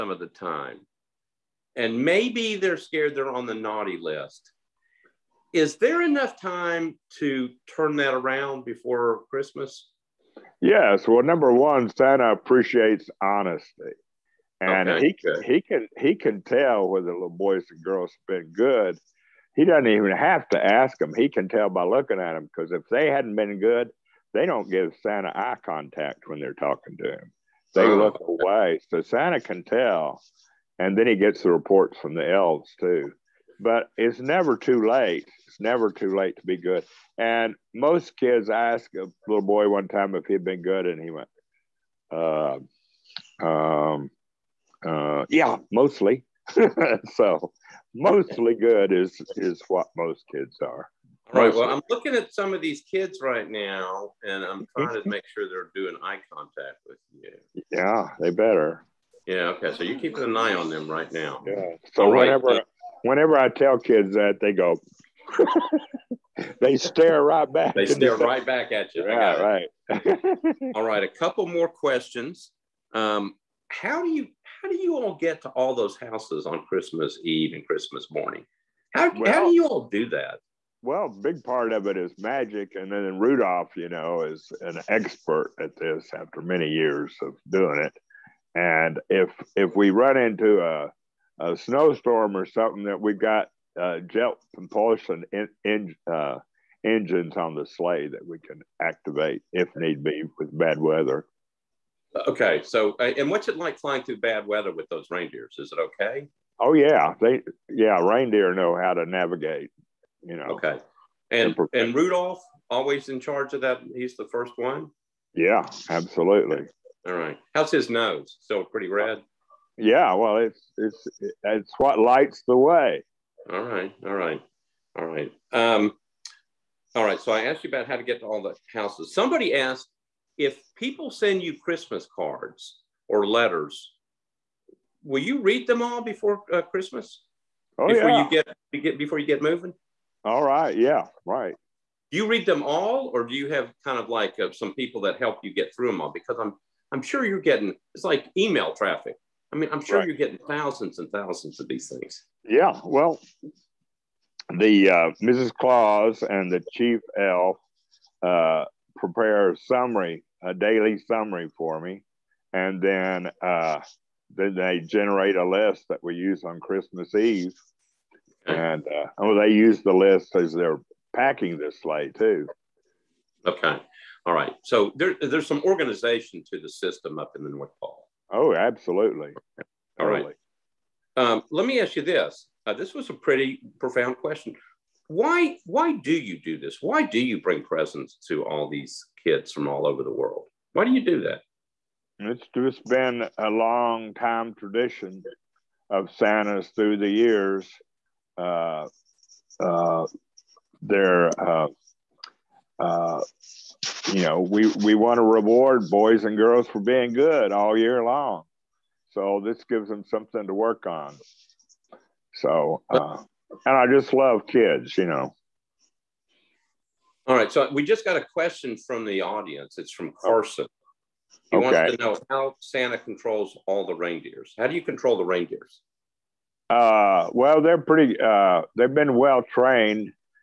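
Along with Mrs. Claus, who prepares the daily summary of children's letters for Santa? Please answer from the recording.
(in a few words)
The chief elf.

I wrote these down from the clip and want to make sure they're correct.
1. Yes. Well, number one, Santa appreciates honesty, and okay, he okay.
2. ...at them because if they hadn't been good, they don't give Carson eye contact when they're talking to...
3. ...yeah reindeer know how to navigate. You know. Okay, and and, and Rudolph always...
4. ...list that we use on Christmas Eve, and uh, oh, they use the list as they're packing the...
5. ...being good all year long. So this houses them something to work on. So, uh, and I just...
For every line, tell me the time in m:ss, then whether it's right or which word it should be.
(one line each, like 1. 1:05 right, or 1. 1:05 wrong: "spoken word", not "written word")
1. 0:10 right
2. 0:22 wrong: "Santa", not "Carson"
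3. 1:47 right
4. 2:45 right
5. 3:26 wrong: "gives", not "houses".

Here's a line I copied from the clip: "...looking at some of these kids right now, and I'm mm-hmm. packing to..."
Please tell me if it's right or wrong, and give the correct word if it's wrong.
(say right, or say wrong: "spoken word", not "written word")
wrong: "trying", not "packing".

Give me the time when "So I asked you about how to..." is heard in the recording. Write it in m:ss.
2:07.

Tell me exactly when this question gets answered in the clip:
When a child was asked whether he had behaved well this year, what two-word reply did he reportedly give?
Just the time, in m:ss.
0:45.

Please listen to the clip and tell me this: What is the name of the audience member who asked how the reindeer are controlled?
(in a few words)
Carson.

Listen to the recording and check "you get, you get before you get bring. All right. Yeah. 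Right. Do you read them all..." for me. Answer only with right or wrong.
wrong.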